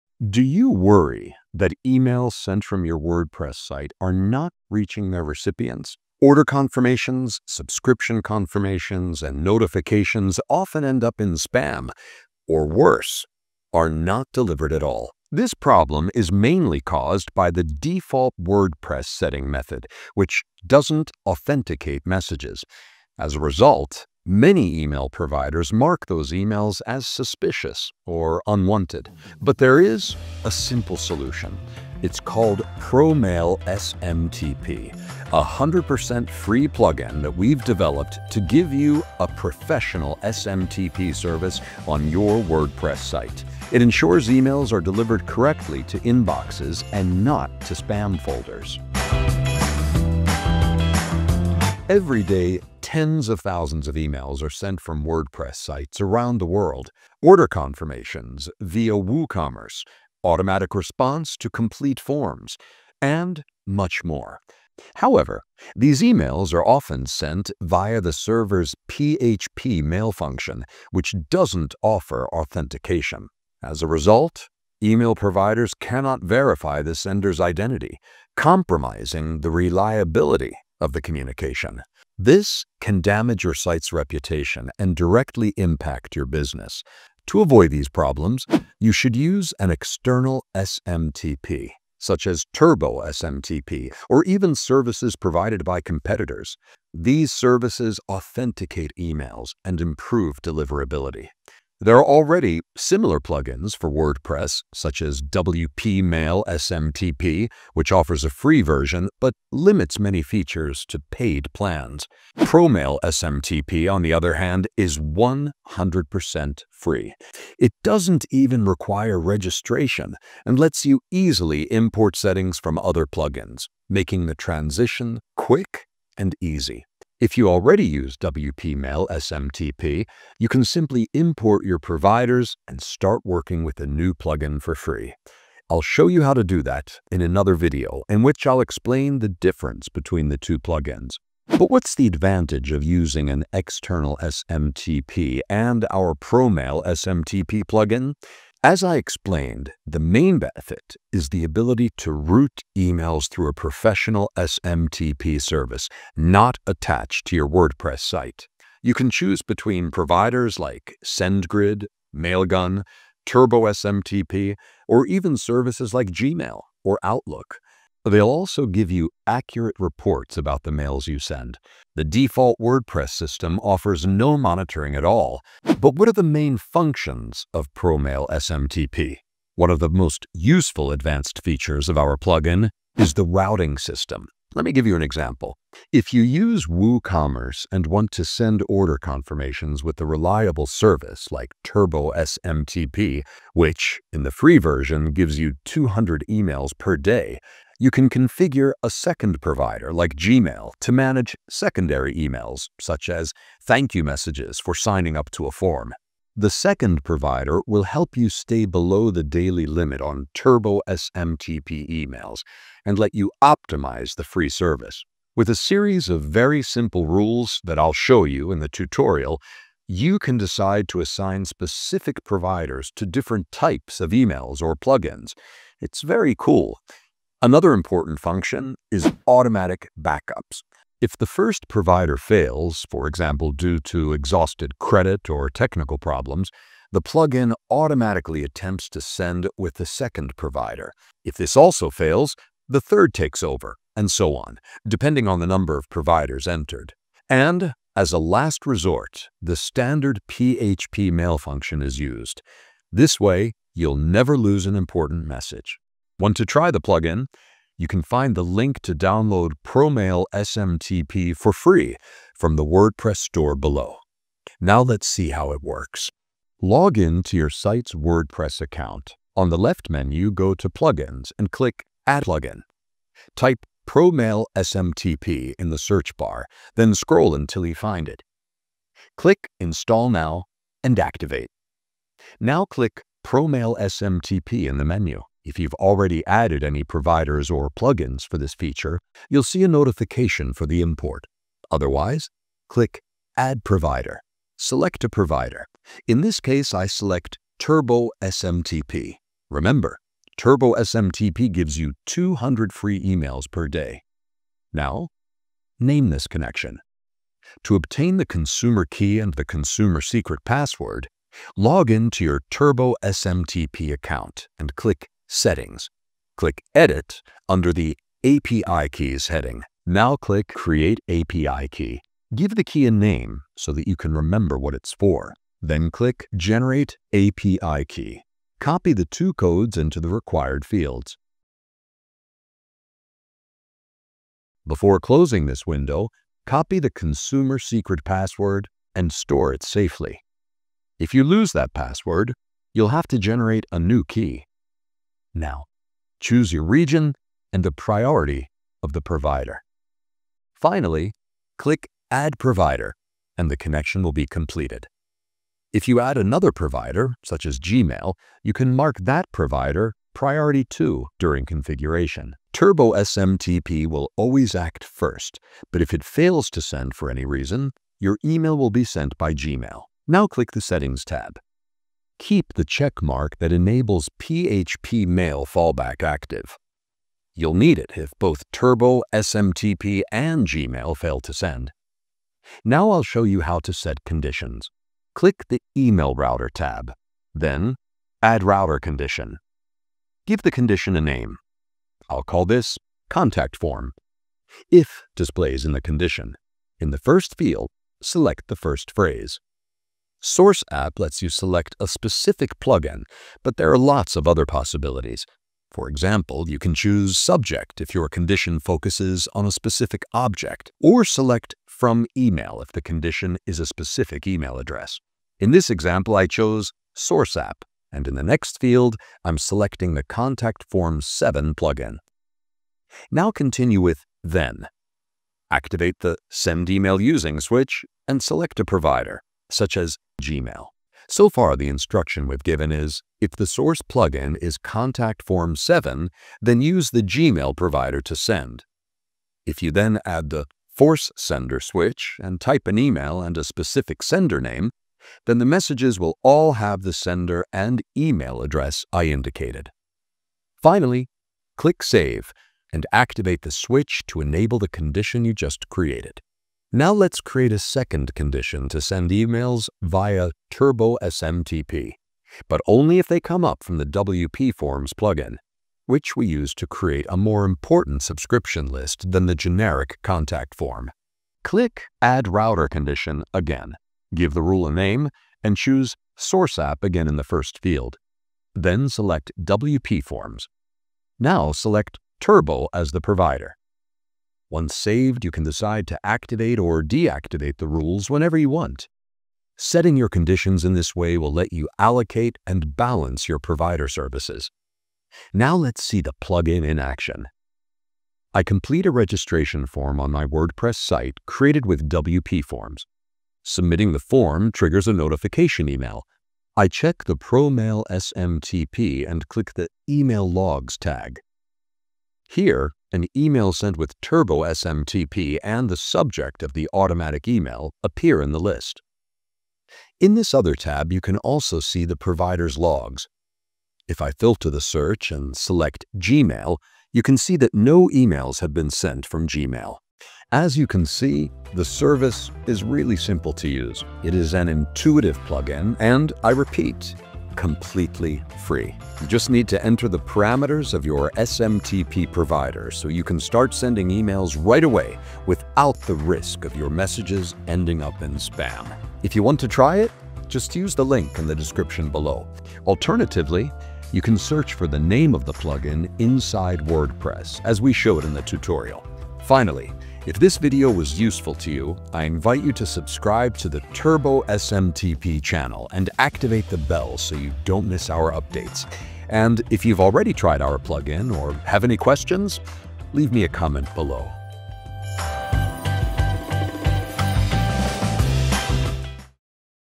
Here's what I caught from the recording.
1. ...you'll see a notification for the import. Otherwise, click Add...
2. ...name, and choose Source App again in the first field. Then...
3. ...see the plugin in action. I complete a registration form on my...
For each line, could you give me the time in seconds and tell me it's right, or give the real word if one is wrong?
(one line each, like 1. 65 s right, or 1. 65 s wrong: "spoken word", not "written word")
1. 289 s right
2. 474 s right
3. 495 s right.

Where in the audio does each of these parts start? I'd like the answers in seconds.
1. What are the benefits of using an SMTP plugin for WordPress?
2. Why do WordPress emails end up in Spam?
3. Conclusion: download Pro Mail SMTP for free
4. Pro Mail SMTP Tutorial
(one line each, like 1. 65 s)
1. 141 s
2. 51 s
3. 530 s
4. 264 s.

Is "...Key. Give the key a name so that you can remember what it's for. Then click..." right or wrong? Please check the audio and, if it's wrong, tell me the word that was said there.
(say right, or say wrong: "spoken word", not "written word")
right.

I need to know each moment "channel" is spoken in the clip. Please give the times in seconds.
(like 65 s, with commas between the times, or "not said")
565 s.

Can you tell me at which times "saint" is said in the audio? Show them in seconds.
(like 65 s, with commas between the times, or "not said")
not said.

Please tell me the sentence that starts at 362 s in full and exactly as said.
Turbo SMTP will always act first, but if it fails to send for any reason, your email will be sent by Gmail.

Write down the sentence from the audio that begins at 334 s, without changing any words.
Before closing this window, copy the consumer secret password and store it safely.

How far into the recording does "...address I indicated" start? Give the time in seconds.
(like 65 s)
448 s.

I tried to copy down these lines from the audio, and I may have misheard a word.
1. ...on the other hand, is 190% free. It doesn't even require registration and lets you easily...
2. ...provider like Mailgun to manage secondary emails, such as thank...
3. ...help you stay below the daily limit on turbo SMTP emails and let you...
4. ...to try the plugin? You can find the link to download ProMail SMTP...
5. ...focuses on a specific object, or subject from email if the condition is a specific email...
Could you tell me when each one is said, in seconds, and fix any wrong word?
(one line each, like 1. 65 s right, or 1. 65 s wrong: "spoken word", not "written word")
1. 113 s wrong: "100", not "190"
2. 199 s wrong: "Gmail", not "Mailgun"
3. 207 s right
4. 256 s right
5. 408 s wrong: "select", not "subject".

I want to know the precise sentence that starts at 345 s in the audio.
Now, choose your region and the priority of the provider.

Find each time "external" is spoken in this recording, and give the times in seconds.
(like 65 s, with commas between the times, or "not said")
89 s, 143 s.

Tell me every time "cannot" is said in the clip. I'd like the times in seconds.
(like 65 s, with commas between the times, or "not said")
75 s.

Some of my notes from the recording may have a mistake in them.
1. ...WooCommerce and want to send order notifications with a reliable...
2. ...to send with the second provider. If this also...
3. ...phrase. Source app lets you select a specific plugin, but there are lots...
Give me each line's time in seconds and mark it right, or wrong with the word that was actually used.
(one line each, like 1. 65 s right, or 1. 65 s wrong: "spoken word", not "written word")
1. 186 s wrong: "confirmations", not "notifications"
2. 238 s right
3. 398 s right.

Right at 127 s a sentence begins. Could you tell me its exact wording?
If you already use WPMail SMTP, you can simply import your providers and start working with a new plugin for free.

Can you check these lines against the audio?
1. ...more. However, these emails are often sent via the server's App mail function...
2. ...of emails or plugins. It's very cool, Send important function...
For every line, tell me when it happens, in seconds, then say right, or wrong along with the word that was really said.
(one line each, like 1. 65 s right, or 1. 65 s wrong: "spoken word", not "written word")
1. 64 s wrong: "PHP", not "App"
2. 223 s wrong: "Another", not "Send".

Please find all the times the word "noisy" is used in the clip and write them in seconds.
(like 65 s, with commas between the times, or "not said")
not said.